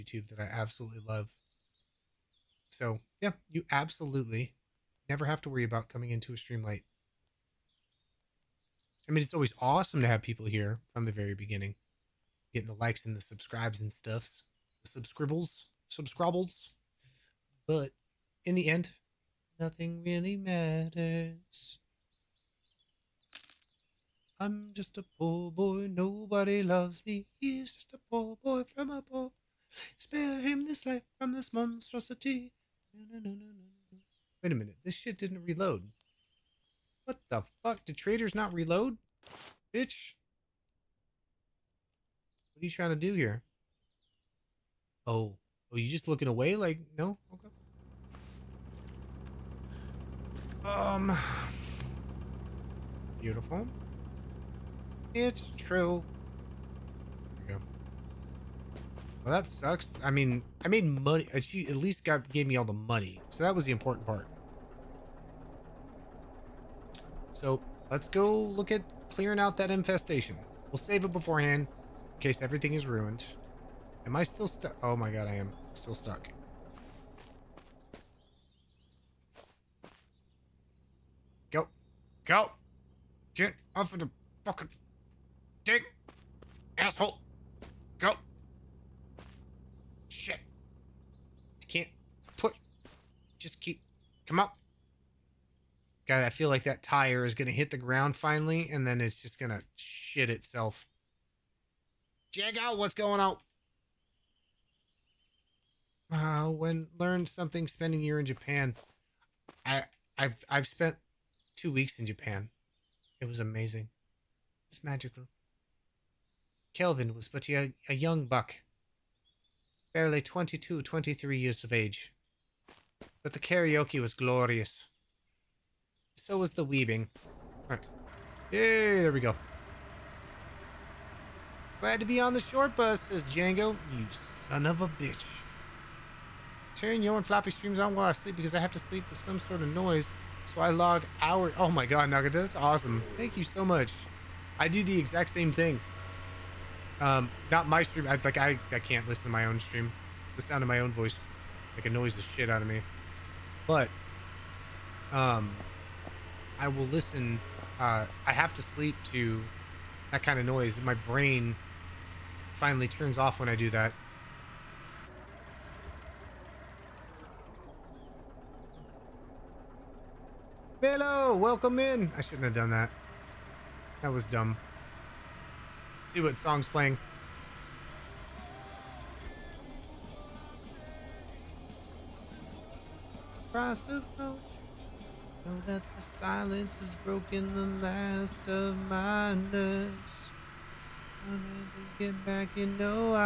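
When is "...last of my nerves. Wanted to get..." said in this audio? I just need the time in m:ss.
3:07.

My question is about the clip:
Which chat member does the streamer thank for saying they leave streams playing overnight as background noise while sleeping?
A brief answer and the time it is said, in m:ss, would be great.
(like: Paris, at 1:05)
Nagata, at 2:22.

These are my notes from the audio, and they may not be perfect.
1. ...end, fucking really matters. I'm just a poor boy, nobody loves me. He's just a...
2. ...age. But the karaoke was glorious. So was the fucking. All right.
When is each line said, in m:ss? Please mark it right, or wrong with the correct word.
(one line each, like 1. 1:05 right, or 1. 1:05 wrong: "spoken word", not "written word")
1. 0:18 wrong: "nothing", not "fucking"
2. 2:01 wrong: "weaving", not "fucking".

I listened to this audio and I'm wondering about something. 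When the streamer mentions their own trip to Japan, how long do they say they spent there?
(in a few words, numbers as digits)
2 weeks.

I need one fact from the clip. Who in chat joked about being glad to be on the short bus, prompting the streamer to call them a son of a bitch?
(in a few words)
Django.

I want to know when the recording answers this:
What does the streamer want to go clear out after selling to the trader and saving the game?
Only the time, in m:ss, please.
1:09.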